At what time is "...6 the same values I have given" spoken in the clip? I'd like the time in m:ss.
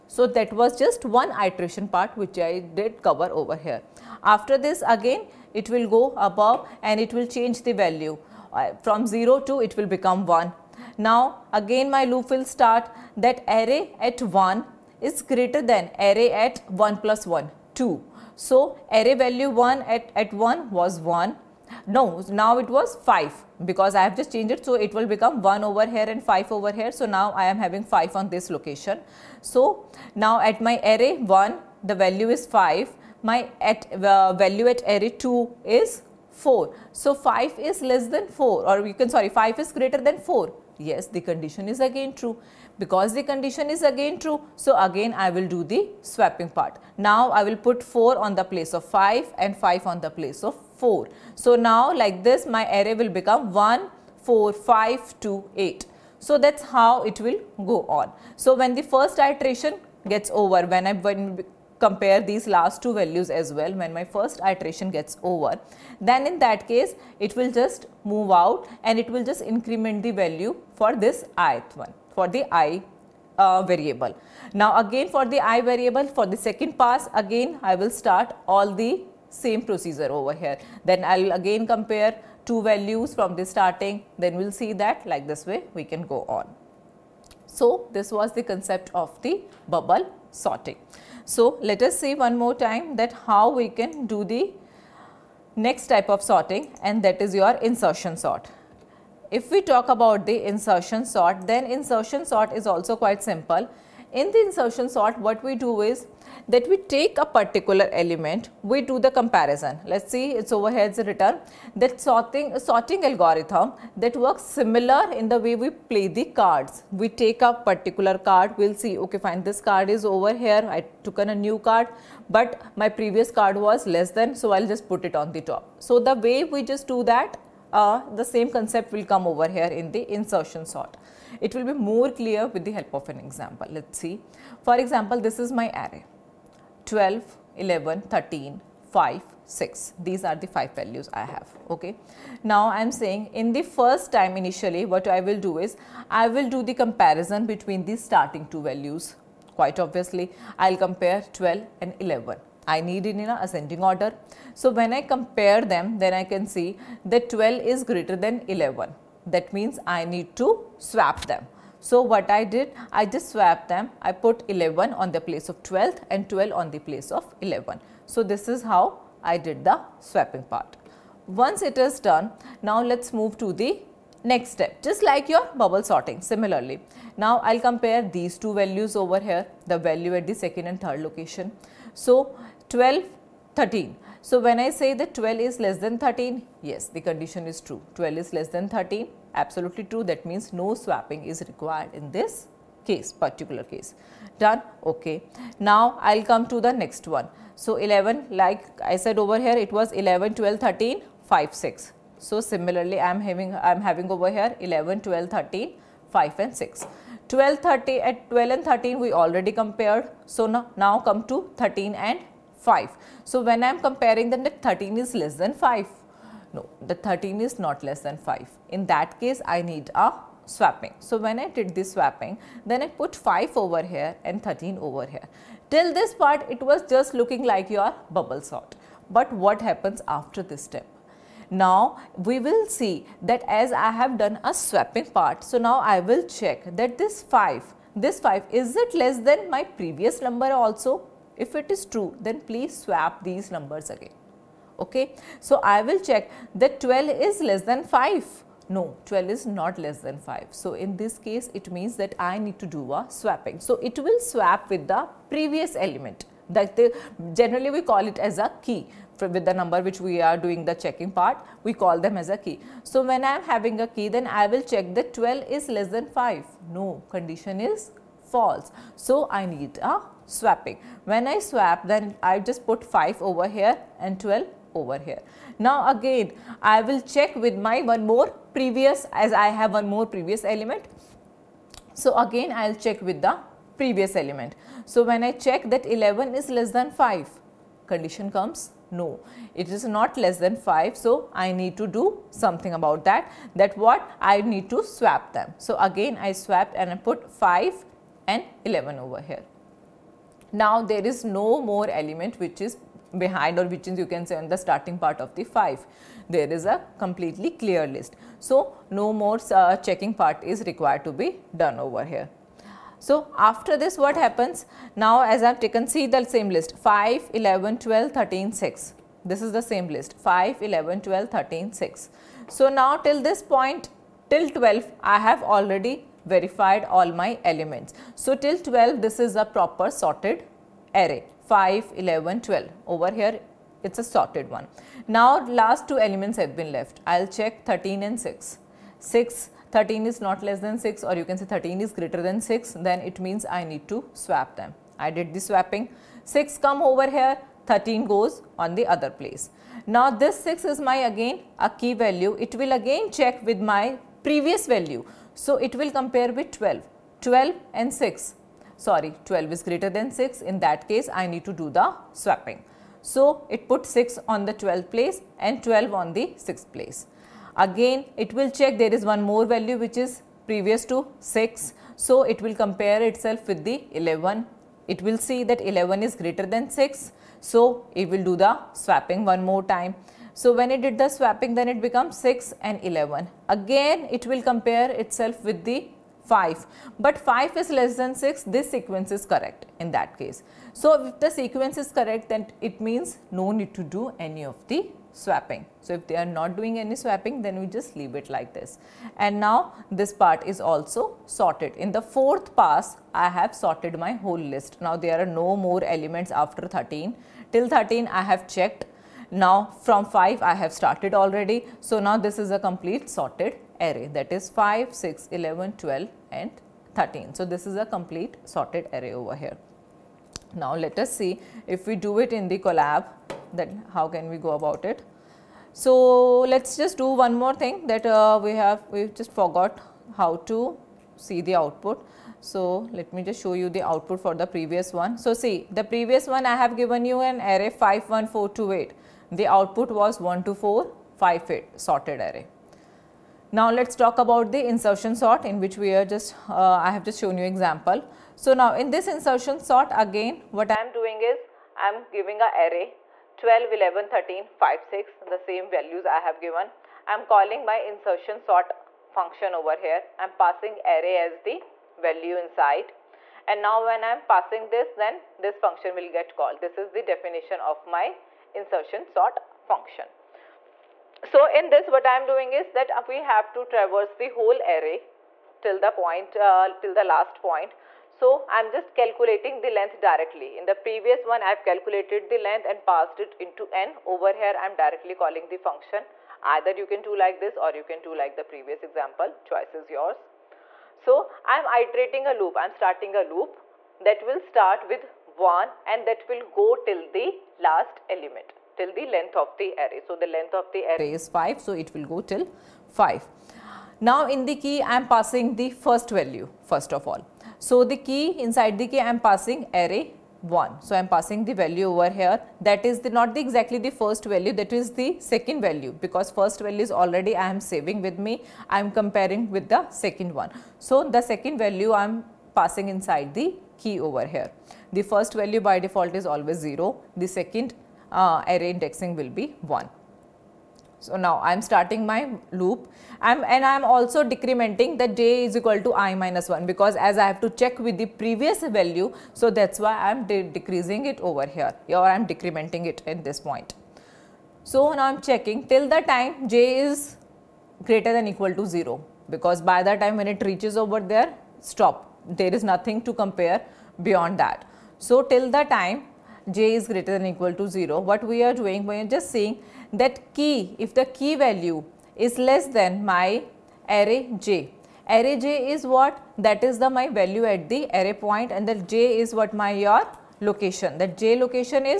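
7:34.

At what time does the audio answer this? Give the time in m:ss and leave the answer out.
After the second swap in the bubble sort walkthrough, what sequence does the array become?
0:53.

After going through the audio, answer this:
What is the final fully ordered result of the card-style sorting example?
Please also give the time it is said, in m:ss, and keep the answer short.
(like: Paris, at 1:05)
5, 6, 11, 12, 13, at 6:54.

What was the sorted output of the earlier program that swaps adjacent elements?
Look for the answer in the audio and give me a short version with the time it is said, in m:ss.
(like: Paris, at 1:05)
1, 2, 4, 5, 8, at 7:20.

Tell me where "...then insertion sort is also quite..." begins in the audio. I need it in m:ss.
1:41.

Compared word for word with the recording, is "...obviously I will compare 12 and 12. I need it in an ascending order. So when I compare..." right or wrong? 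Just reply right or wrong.
wrong.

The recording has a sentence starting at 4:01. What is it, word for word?
If it is true, then please swap these numbers again okay.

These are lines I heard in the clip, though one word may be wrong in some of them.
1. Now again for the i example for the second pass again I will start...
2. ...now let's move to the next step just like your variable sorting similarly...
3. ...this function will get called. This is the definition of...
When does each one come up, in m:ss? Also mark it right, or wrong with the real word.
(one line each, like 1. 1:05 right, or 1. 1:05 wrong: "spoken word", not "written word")
1. 1:14 wrong: "variable", not "example"
2. 2:52 wrong: "bubble", not "variable"
3. 7:45 right.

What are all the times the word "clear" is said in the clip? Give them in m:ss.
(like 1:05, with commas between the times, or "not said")
2:12, 5:07.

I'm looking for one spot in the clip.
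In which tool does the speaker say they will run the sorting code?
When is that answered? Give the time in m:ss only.
7:02.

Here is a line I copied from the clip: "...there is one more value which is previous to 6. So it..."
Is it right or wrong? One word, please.
right.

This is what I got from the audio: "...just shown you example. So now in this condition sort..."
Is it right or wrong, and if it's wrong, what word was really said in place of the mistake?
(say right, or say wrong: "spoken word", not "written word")
wrong: "insertion", not "condition".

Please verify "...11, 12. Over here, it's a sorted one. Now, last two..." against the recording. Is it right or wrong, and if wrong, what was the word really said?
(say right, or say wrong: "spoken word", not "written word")
right.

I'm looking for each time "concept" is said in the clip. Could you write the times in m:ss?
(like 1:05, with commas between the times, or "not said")
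1:28, 2:08.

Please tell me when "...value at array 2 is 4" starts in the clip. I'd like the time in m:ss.
0:34.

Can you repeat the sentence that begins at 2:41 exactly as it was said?
So what I did, I just swapped them.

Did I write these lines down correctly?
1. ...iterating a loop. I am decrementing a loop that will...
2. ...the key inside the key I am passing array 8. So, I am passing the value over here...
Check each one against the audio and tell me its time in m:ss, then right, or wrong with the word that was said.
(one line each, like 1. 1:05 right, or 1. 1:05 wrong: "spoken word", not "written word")
1. 8:11 wrong: "starting", not "decrementing"
2. 8:27 wrong: "1", not "8".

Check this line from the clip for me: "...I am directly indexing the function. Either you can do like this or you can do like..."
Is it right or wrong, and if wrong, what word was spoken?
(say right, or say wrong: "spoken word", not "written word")
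wrong: "calling", not "indexing".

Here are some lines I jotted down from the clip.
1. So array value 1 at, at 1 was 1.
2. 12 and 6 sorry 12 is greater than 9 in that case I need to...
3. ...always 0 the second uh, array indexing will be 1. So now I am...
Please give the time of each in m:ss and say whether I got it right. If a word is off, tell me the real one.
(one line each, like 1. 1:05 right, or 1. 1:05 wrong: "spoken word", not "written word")
1. 0:18 right
2. 5:57 wrong: "6", not "9"
3. 8:46 right.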